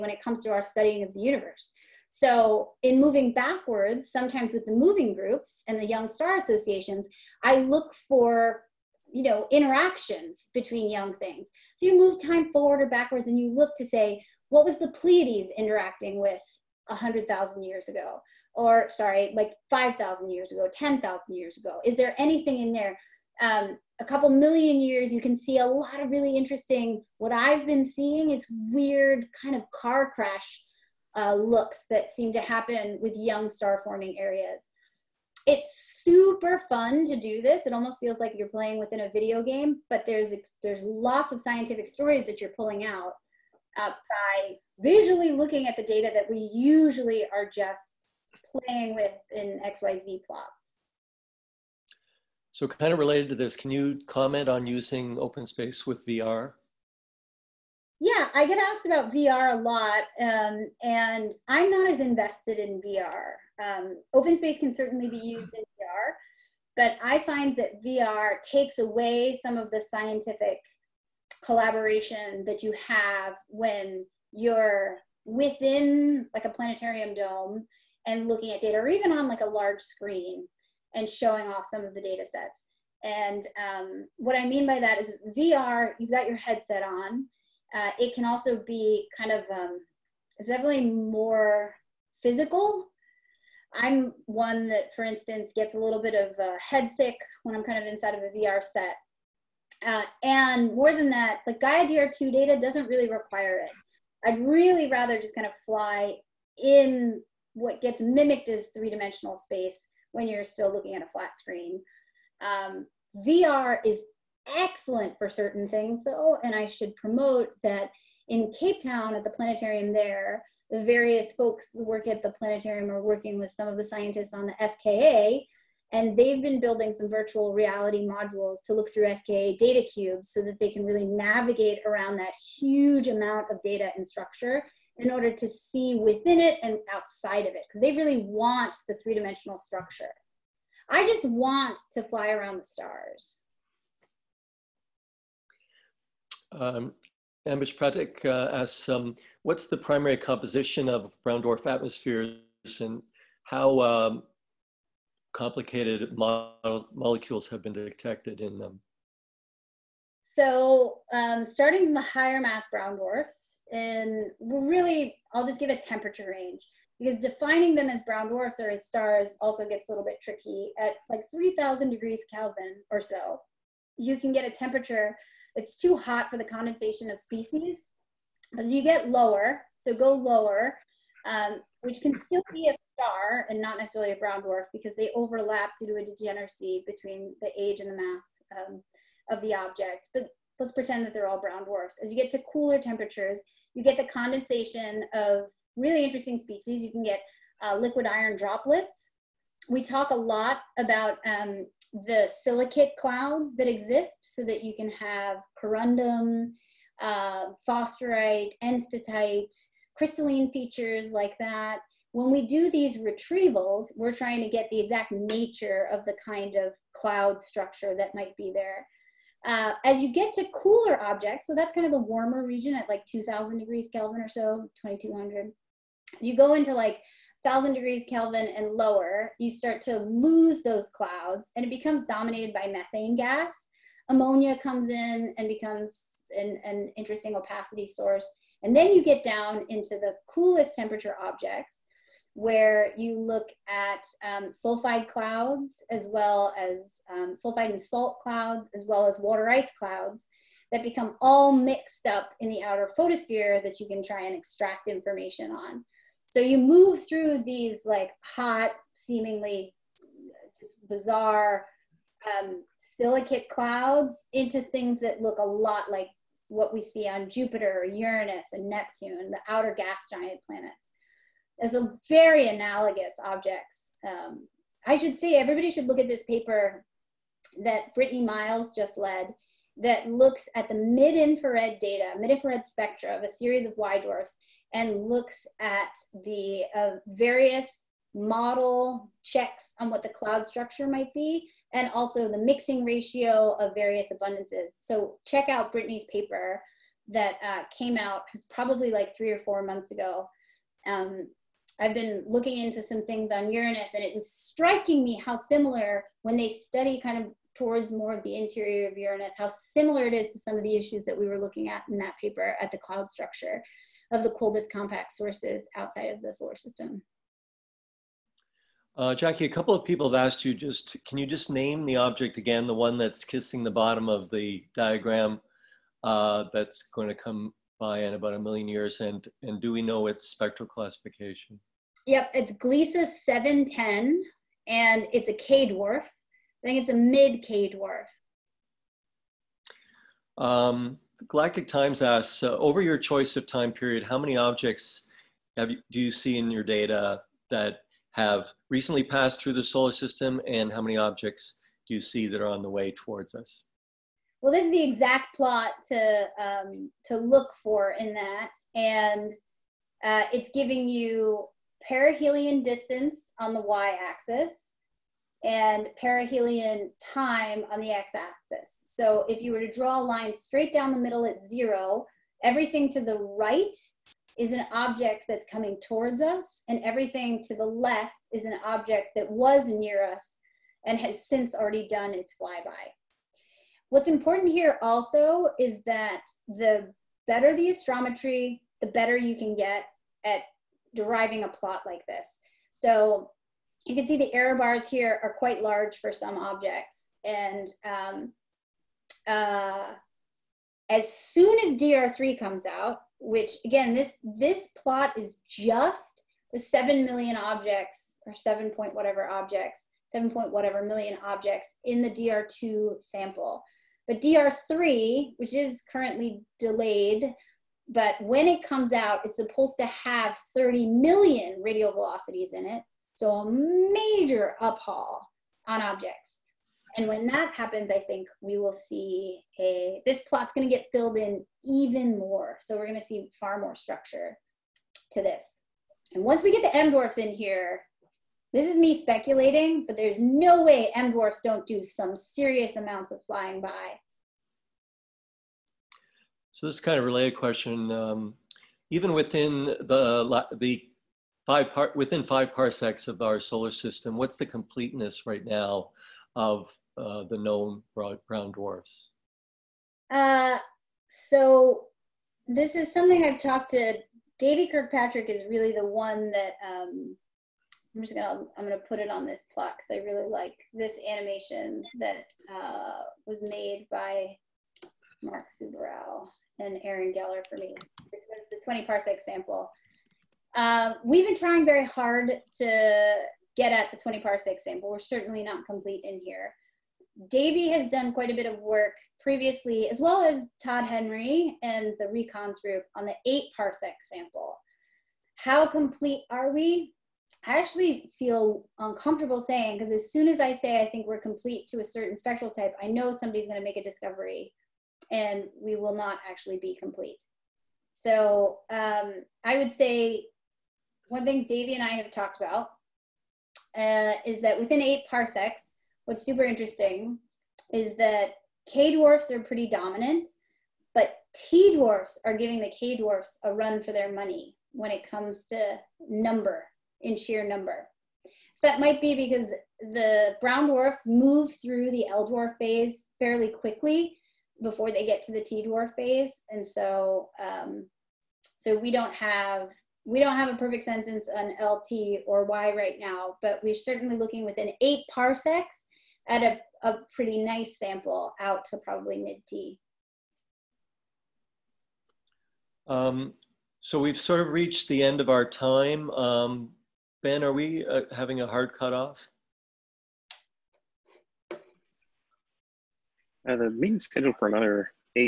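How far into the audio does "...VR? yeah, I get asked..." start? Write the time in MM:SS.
00:56.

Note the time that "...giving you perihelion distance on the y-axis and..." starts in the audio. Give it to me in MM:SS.
06:00.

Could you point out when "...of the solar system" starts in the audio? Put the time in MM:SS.
05:16.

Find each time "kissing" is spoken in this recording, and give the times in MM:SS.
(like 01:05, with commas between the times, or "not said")
05:23.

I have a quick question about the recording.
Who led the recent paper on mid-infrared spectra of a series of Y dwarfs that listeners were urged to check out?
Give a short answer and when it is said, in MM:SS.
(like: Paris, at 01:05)
Brittany Miles, at 04:37.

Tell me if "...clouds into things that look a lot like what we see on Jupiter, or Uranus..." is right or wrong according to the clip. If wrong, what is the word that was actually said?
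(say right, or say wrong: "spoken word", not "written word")
right.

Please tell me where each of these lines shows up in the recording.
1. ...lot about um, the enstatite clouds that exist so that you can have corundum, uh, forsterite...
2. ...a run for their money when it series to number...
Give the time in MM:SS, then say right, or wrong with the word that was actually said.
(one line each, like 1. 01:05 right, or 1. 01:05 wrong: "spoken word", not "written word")
1. 03:20 wrong: "silicate", not "enstatite"
2. 08:43 wrong: "comes", not "series".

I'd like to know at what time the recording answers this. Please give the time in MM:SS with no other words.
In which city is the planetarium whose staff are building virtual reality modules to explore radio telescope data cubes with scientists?
01:58.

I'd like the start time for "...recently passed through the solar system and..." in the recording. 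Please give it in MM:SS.
05:48.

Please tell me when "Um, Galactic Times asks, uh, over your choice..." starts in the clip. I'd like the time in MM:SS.
05:40.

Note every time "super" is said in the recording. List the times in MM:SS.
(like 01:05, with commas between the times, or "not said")
00:36, 08:36.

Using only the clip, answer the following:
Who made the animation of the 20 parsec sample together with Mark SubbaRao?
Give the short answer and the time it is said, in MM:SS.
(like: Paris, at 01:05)
Aaron Geller, at 07:56.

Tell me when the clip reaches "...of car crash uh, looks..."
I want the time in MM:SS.
00:29.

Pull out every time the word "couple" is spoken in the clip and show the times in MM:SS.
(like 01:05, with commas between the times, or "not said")
00:24, 05:19.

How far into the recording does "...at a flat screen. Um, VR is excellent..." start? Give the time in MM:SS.
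01:50.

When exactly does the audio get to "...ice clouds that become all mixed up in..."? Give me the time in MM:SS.
04:09.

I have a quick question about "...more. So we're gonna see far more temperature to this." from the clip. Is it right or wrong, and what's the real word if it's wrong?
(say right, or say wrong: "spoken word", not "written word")
wrong: "structure", not "temperature".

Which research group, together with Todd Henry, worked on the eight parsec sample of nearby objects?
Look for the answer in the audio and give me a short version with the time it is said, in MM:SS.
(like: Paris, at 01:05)
RECONS, at 08:12.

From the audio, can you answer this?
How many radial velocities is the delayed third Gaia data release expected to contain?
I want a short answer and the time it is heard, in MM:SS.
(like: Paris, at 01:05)
30 million, at 07:00.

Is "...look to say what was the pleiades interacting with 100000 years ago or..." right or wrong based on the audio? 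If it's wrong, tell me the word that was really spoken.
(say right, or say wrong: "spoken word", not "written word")
right.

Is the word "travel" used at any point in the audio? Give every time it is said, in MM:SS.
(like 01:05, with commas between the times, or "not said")
not said.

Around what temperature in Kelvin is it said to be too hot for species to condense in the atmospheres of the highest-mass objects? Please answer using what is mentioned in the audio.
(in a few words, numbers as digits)
3,000.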